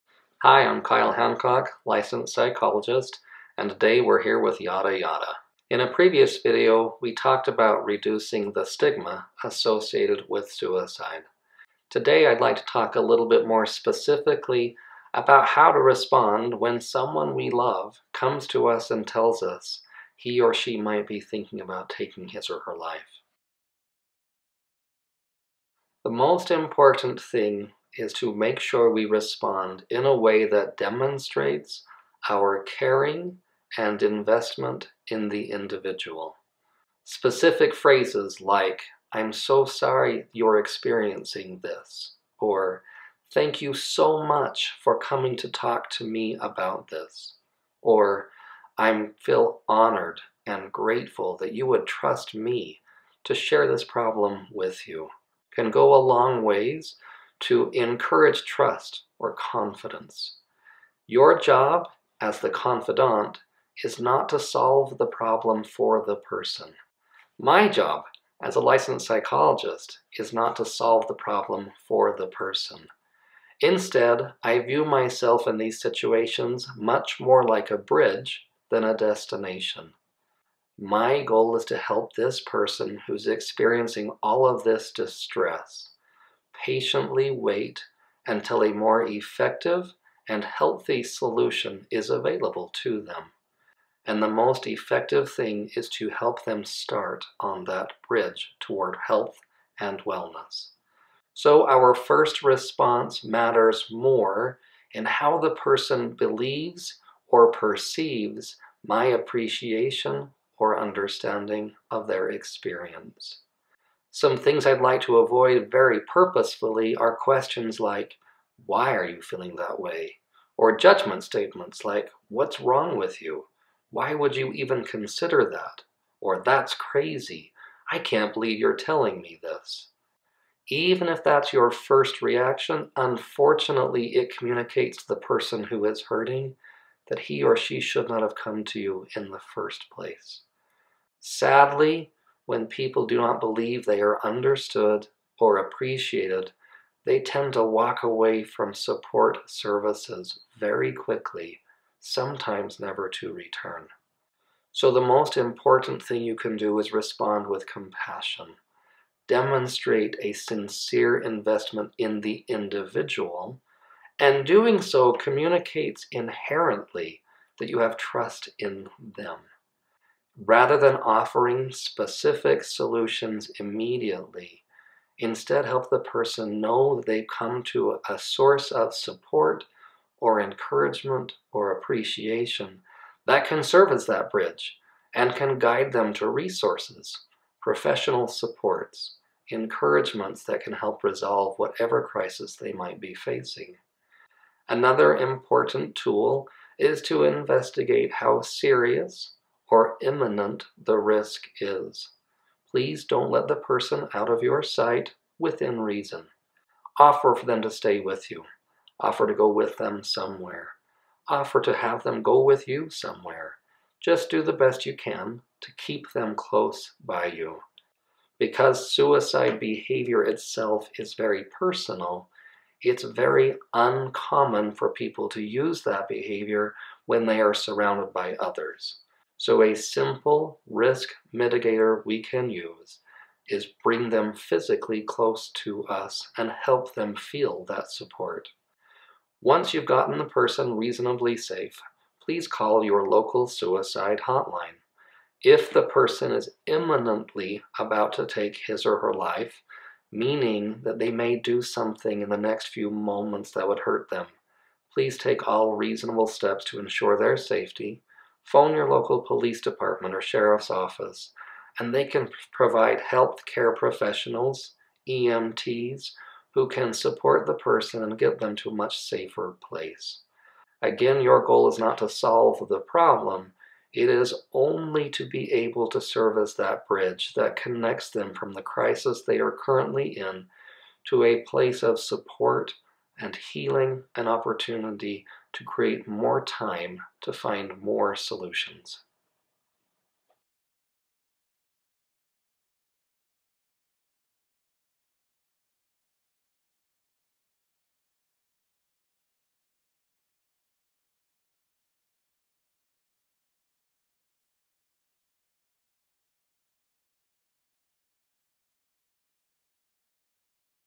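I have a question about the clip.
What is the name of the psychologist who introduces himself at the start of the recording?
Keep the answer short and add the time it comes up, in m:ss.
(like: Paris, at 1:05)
Kyle Hancock, at 0:00.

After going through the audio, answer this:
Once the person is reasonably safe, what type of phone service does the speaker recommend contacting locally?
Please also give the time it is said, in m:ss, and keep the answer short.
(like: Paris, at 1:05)
Suicide hotline, at 4:03.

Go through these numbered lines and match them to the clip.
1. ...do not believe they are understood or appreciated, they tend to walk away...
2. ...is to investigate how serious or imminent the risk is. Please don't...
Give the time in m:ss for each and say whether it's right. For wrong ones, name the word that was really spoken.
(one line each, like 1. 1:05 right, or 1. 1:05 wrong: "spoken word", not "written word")
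1. 2:23 right
2. 3:16 right.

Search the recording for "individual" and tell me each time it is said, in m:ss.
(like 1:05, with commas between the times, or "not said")
0:35, 2:42.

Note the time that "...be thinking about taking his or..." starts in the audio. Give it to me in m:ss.
0:21.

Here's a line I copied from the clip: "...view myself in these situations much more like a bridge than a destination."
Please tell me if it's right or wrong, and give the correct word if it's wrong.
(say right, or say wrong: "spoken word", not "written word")
right.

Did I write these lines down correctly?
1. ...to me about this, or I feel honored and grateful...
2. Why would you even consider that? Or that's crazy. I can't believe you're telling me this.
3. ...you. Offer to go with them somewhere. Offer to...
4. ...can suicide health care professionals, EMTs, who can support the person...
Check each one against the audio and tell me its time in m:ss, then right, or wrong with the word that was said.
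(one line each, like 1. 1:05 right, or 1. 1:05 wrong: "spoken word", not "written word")
1. 0:45 right
2. 2:03 right
3. 3:28 right
4. 4:22 wrong: "provide", not "suicide".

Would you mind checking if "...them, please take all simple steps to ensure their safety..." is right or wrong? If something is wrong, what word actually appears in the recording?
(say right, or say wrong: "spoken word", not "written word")
wrong: "reasonable", not "simple".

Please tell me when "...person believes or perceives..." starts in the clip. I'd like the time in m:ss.
1:45.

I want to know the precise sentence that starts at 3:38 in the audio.
Because suicide behavior itself is very personal, it's very uncommon for people to use that behavior when they are surrounded by others.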